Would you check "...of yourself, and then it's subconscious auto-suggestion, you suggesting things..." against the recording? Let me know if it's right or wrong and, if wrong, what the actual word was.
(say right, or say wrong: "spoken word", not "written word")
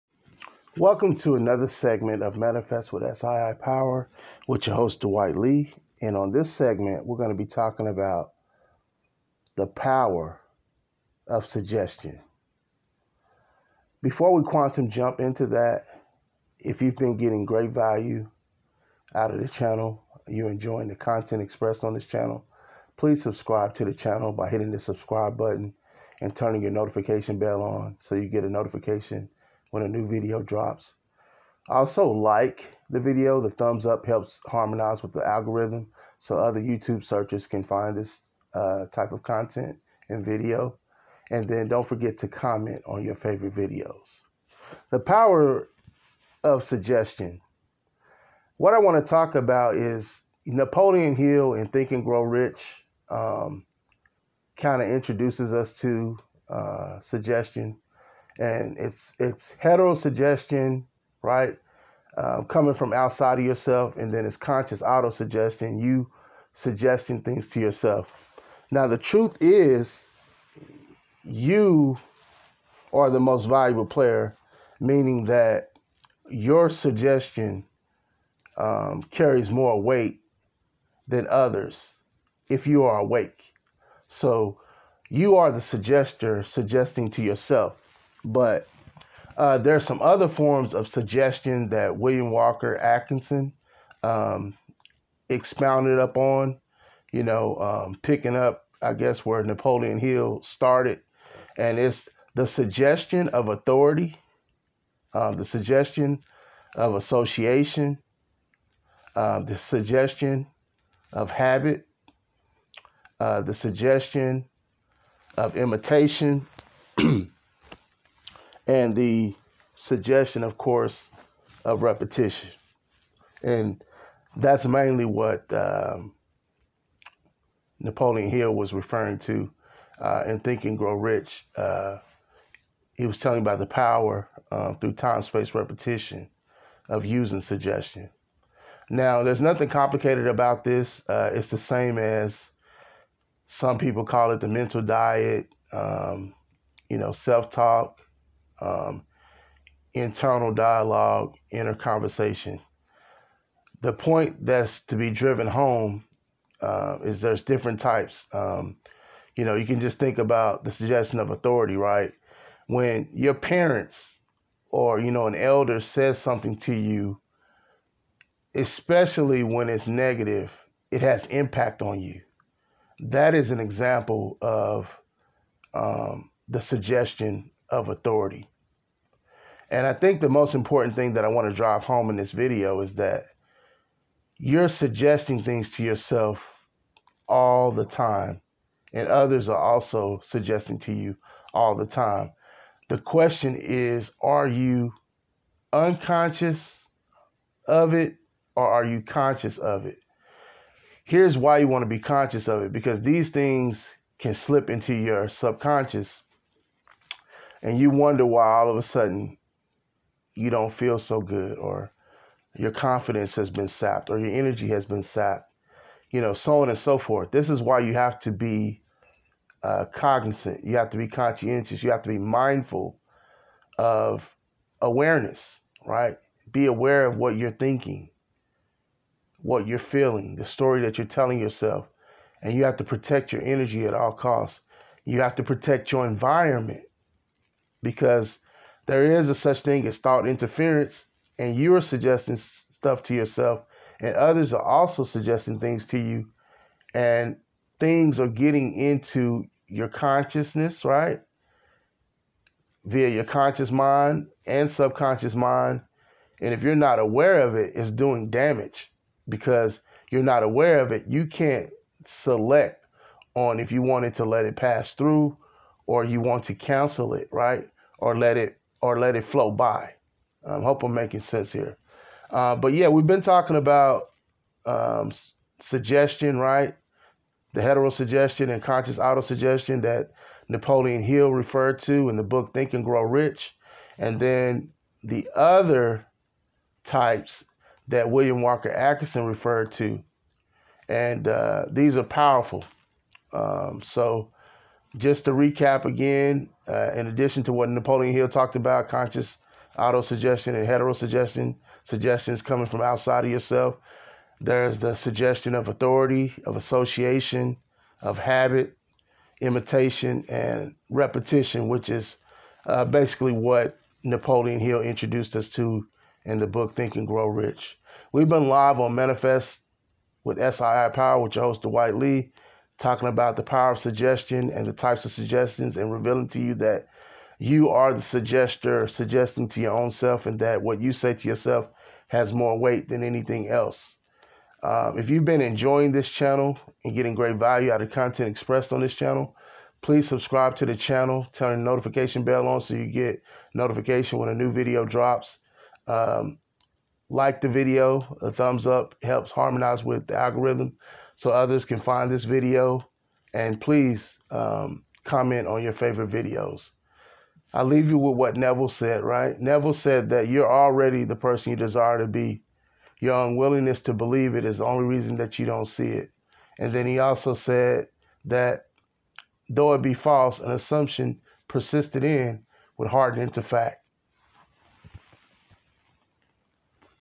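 wrong: "conscious", not "subconscious".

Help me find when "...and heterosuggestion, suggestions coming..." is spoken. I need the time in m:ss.
5:00.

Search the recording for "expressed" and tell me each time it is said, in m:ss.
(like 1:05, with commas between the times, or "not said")
0:21, 5:38.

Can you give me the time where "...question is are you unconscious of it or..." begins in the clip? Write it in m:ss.
3:12.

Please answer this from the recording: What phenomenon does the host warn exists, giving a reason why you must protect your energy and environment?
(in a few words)
thought interference.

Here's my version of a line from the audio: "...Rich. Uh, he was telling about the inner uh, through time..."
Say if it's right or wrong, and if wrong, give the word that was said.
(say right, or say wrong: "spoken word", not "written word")
wrong: "power", not "inner".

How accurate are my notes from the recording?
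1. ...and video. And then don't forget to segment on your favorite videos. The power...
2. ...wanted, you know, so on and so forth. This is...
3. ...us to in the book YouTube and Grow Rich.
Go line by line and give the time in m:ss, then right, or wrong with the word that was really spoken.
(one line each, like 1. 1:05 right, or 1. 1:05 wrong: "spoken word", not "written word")
1. 0:40 wrong: "comment", not "segment"
2. 3:35 wrong: "sapped", not "wanted"
3. 5:15 wrong: "Think", not "YouTube".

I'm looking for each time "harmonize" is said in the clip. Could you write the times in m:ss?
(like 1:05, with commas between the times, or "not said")
0:34, 5:49.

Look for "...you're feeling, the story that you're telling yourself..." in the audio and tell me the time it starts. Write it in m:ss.
3:49.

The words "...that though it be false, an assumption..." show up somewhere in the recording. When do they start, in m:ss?
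6:08.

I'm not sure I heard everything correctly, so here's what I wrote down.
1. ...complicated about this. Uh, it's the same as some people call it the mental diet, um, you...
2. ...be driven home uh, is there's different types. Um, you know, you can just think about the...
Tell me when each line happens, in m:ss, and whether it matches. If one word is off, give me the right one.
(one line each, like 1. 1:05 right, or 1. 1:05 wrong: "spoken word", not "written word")
1. 2:19 right
2. 2:34 right.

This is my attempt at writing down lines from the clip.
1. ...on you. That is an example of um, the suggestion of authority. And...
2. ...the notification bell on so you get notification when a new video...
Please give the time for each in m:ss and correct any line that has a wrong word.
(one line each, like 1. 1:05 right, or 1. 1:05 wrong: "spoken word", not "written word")
1. 2:51 right
2. 5:41 right.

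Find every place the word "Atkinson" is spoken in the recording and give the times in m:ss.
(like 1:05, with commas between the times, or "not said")
1:32, 4:48.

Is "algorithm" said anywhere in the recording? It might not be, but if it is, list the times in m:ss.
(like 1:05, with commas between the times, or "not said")
0:35, 5:50.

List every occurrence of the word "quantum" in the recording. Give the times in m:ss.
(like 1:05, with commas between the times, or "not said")
0:14.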